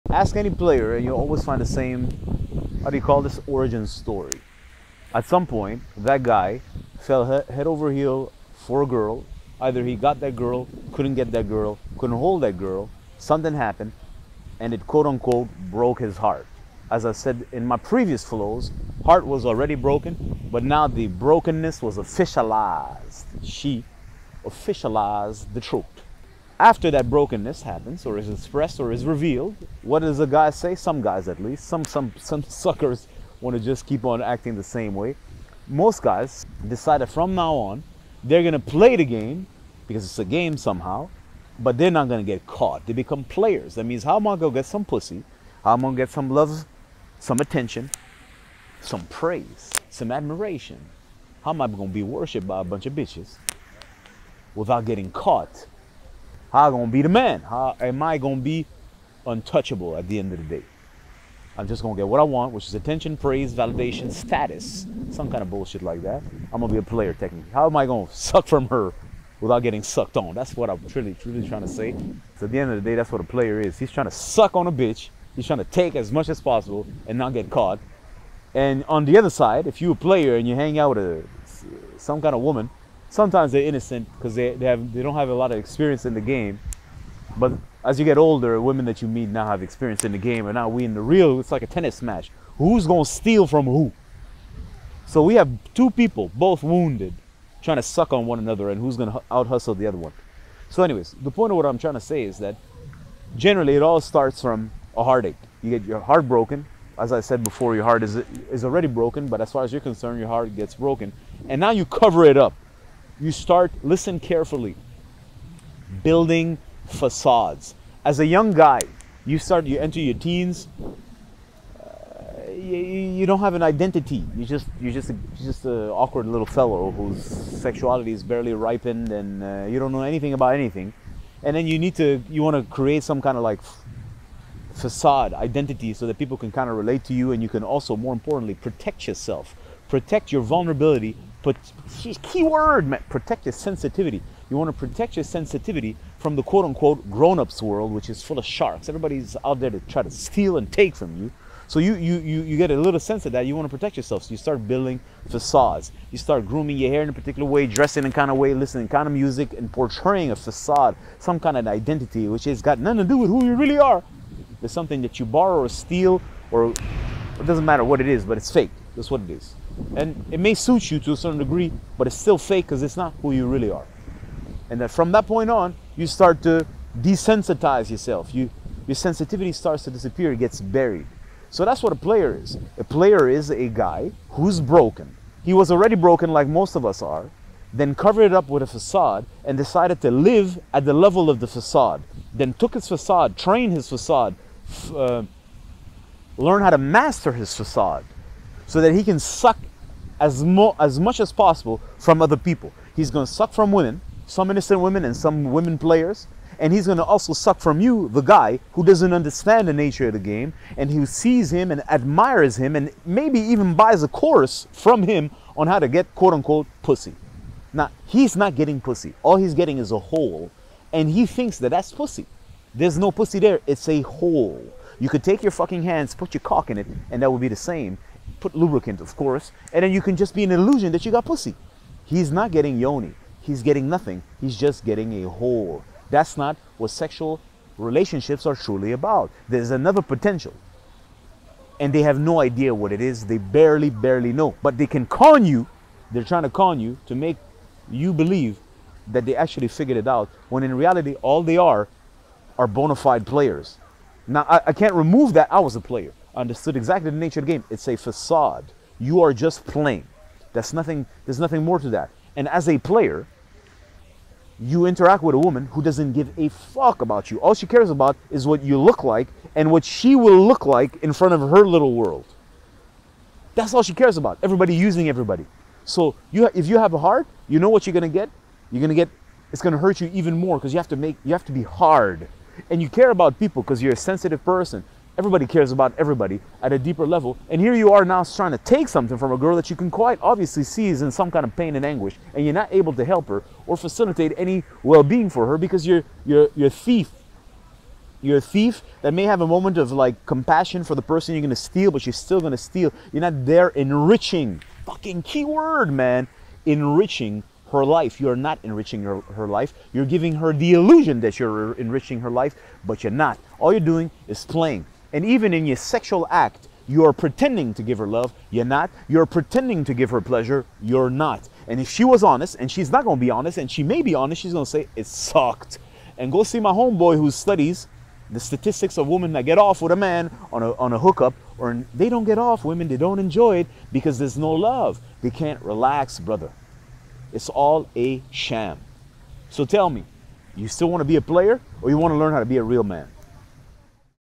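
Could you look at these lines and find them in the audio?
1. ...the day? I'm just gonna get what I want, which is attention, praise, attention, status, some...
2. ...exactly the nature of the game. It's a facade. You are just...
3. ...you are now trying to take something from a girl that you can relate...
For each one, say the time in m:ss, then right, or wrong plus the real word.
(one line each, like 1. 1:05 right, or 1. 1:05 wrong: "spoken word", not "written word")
1. 1:00 wrong: "validation", not "attention"
2. 4:16 right
3. 4:47 wrong: "quite", not "relate".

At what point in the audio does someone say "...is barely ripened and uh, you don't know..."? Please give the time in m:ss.
2:08.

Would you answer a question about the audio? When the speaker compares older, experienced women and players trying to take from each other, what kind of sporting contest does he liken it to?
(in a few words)
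tennis match.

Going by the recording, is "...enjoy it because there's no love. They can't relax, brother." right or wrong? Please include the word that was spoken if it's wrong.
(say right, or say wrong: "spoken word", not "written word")
right.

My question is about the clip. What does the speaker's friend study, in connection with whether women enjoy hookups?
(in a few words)
statistics.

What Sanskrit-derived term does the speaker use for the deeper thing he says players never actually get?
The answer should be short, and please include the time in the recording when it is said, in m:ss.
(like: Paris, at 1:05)
yoni, at 3:52.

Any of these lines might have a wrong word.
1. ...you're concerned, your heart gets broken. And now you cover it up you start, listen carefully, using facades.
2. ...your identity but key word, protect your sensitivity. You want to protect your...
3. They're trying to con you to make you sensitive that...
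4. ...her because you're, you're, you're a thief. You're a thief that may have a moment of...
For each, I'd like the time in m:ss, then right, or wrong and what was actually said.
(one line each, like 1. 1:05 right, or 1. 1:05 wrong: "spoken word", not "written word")
1. 1:49 wrong: "building", not "using"
2. 2:20 wrong: "vulnerability", not "identity"
3. 4:06 wrong: "believe", not "sensitive"
4. 4:55 right.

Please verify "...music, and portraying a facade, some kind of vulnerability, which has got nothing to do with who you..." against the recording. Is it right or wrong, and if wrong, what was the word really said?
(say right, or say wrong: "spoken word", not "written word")
wrong: "identity", not "vulnerability".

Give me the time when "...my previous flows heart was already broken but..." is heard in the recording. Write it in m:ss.
0:17.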